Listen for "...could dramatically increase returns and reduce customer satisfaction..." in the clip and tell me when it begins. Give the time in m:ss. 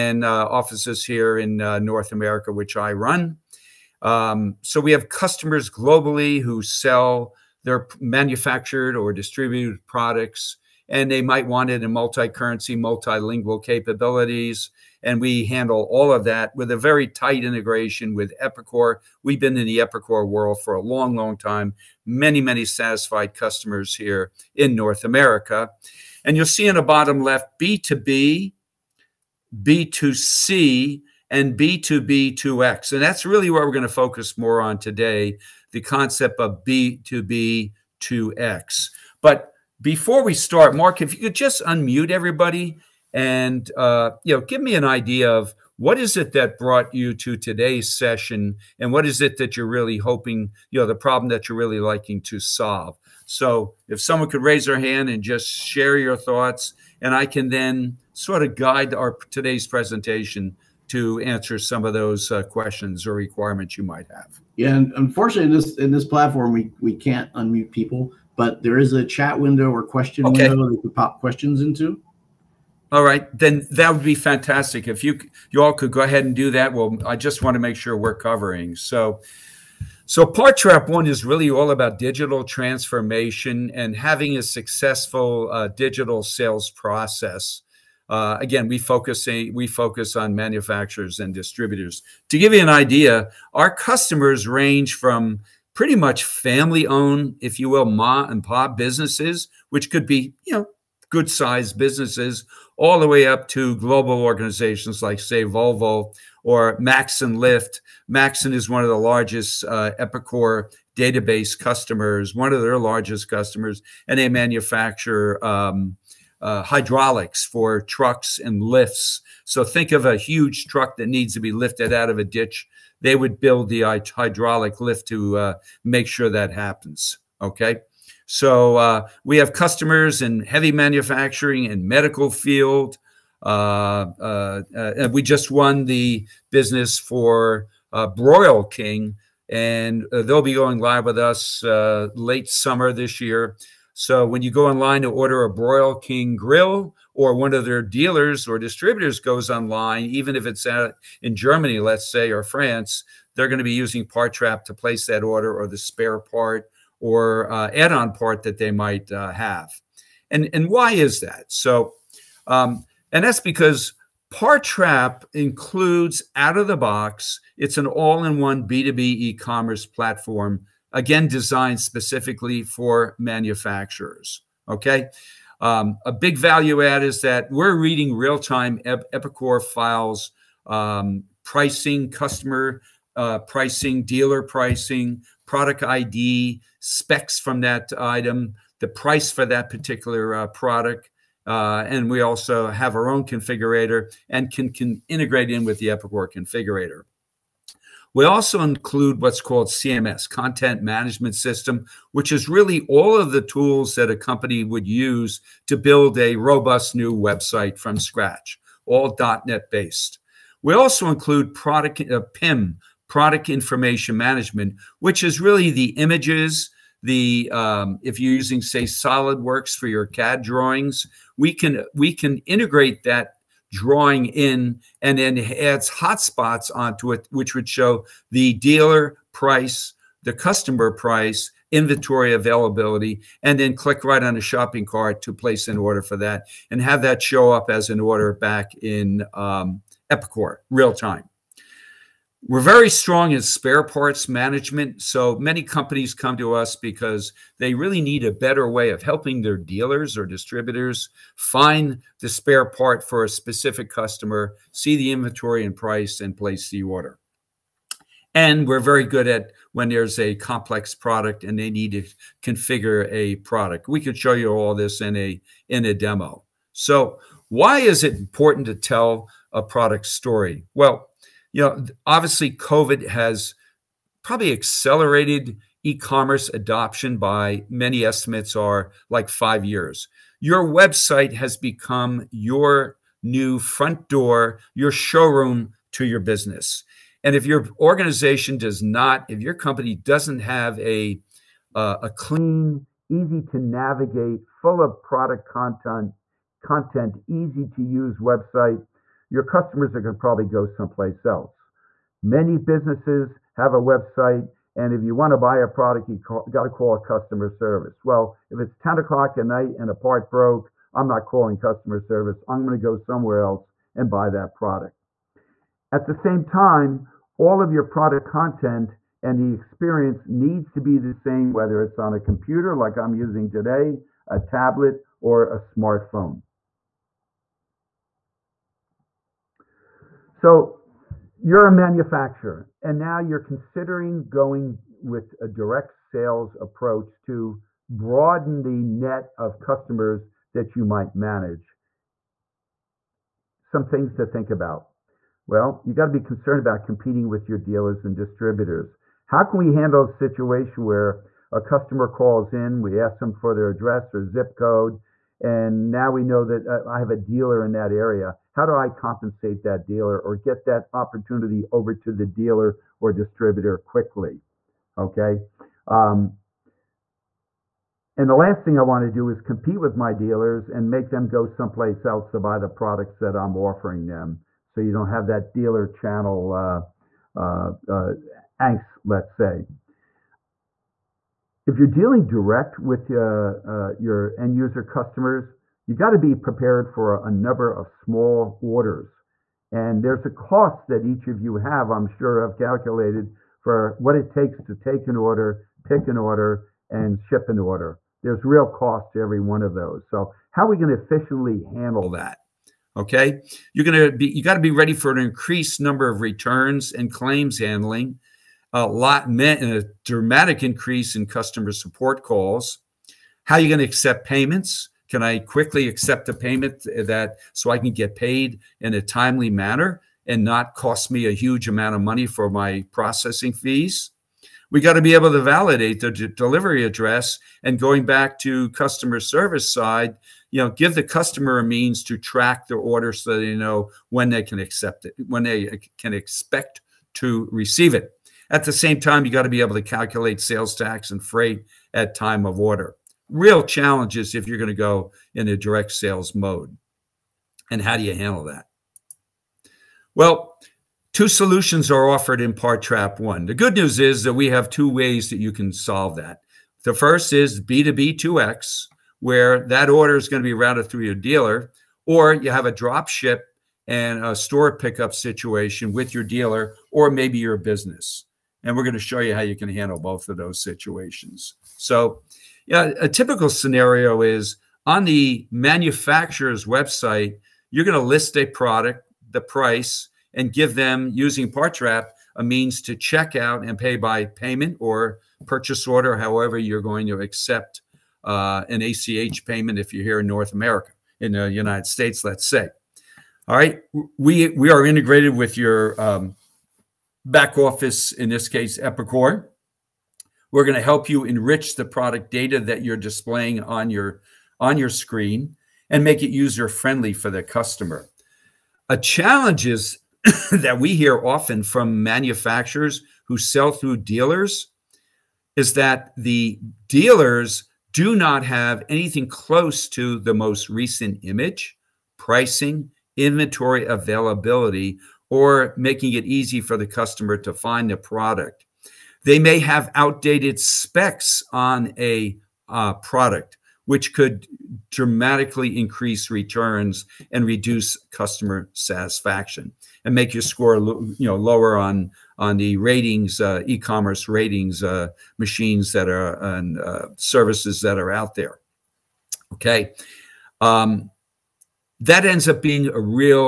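8:54.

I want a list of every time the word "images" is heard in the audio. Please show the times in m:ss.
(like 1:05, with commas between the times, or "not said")
3:35, 8:41.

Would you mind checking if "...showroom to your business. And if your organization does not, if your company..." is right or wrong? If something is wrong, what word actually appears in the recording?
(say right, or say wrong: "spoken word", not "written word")
right.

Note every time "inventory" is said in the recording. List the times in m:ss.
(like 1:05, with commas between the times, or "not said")
3:51, 4:15, 8:43.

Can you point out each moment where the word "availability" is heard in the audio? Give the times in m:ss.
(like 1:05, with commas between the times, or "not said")
3:52, 8:43.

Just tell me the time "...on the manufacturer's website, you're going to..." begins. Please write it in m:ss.
7:54.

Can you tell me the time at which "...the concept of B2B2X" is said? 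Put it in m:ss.
0:35.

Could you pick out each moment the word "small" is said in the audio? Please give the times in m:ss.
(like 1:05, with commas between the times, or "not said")
6:27.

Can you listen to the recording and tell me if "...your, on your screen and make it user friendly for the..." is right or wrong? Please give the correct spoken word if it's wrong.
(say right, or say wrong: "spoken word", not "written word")
right.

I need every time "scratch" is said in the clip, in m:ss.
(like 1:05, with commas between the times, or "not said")
3:27.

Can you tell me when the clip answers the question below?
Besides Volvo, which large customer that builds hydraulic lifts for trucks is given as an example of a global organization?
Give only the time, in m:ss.
1:46.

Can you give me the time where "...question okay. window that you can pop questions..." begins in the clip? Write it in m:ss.
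1:09.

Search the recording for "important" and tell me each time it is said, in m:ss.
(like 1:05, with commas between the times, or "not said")
4:28.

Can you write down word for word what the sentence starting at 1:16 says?
Well, I just want to make sure we're covering.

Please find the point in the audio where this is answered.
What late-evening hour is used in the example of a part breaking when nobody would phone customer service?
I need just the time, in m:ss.
5:08.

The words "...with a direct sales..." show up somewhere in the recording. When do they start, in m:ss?
5:35.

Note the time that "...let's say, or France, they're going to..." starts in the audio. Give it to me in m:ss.
2:31.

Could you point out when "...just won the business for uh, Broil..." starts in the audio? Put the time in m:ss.
2:15.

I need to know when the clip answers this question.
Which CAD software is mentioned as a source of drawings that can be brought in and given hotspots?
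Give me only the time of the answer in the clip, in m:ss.
3:38.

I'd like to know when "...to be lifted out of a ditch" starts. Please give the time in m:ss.
2:01.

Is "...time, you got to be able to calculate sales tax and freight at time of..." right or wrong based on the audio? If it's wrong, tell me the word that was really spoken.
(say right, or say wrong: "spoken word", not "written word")
right.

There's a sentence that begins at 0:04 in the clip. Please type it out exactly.
Um, so we have customers globally who sell their manufactured or distributed products, and they might want it in multi-currency, multilingual capabilities.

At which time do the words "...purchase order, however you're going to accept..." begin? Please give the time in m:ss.
8:05.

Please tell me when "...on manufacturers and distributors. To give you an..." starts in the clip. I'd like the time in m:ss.
1:30.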